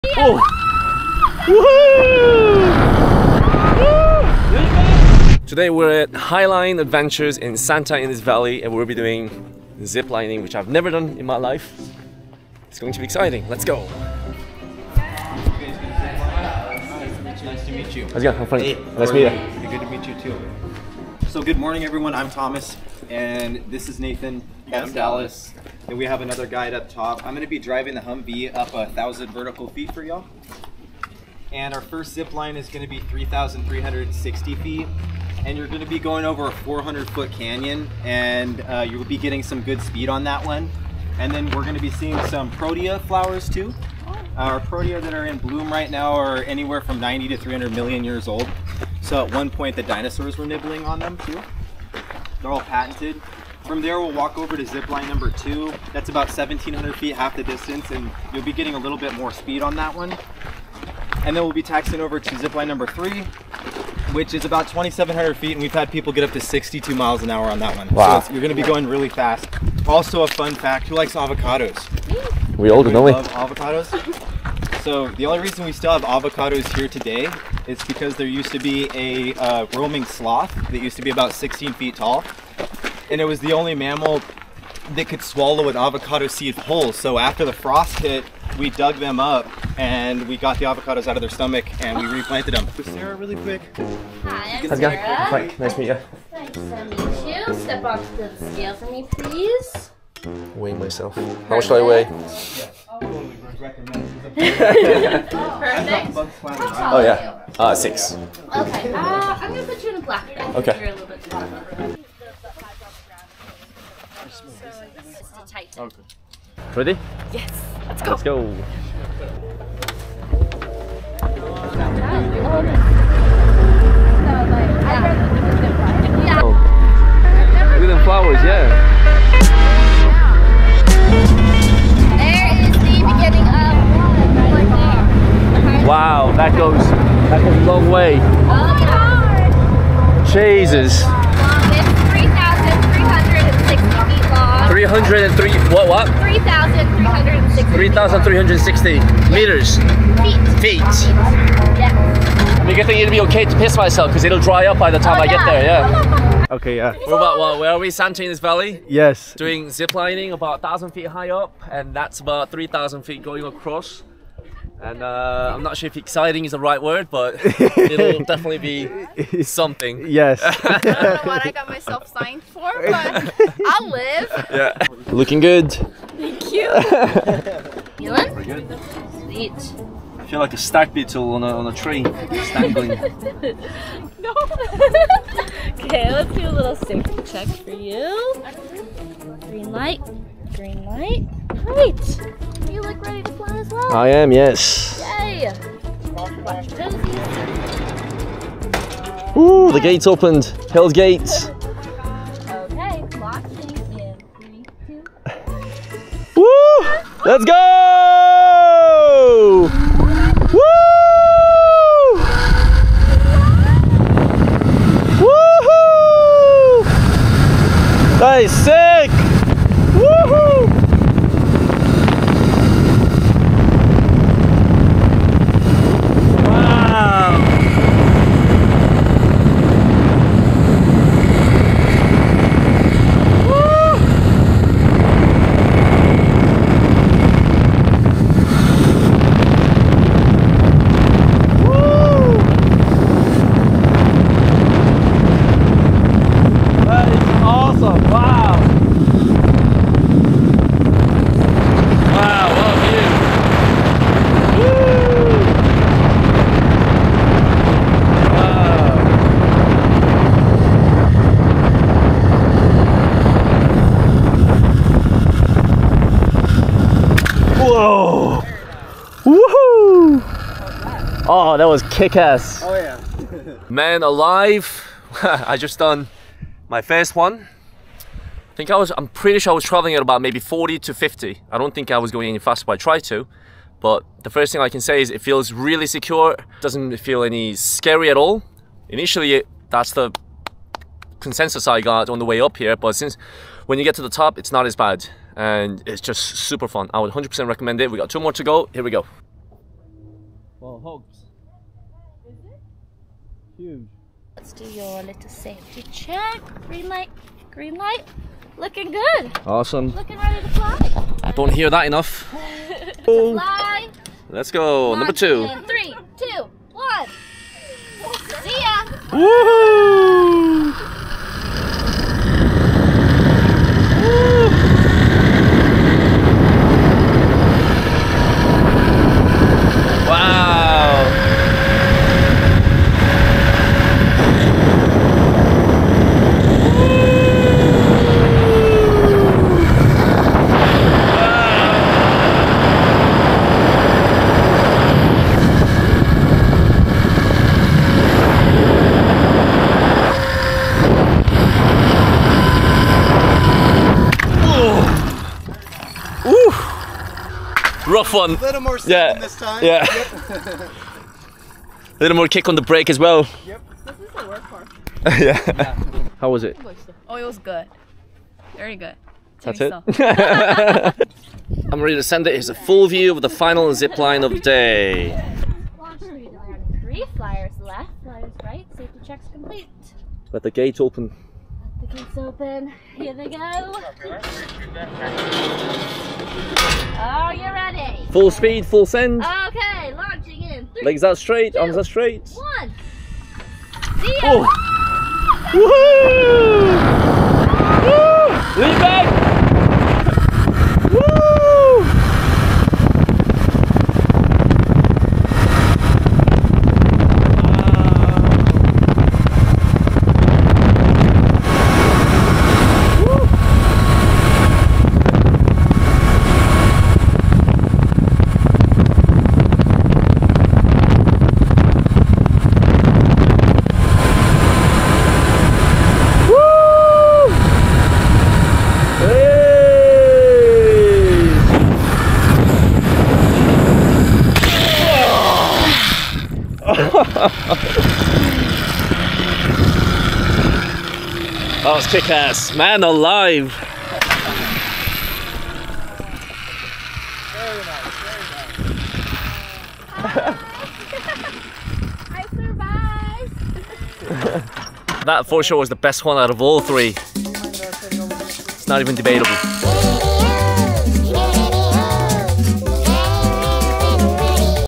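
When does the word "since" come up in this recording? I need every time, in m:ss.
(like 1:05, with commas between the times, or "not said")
4:52.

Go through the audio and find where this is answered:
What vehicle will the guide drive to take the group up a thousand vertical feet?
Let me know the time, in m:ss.
0:28.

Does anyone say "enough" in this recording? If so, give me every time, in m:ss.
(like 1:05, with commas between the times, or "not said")
5:11.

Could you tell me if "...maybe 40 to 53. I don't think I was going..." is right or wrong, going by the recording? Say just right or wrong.
wrong.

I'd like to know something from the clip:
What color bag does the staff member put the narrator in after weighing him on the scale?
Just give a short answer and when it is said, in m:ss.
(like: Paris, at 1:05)
black, at 1:50.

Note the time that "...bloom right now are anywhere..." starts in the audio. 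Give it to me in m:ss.
0:45.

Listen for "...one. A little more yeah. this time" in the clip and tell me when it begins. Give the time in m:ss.
5:58.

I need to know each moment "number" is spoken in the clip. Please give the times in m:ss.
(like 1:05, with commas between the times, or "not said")
0:55, 1:02, 5:14.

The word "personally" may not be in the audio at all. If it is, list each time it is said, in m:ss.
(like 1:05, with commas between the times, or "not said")
not said.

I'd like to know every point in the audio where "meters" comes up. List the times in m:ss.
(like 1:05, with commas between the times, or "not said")
2:29.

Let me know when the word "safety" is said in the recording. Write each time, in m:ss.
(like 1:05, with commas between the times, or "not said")
3:06, 5:05, 6:18.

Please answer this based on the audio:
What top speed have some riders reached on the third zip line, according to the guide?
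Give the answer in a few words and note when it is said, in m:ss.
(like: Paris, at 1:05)
62 miles an hour, at 1:06.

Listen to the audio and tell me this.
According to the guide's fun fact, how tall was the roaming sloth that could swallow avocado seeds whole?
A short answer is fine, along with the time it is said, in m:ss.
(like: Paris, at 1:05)
16 feet, at 1:21.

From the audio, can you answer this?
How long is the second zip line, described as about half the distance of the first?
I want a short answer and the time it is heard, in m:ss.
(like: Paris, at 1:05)
1,700 feet, at 0:56.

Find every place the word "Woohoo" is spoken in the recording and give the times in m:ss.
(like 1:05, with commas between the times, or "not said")
3:35, 4:29, 5:19, 6:38.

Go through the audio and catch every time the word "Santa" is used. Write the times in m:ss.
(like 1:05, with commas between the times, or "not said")
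0:07, 2:37.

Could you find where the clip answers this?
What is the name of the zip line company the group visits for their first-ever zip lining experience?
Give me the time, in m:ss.
0:06.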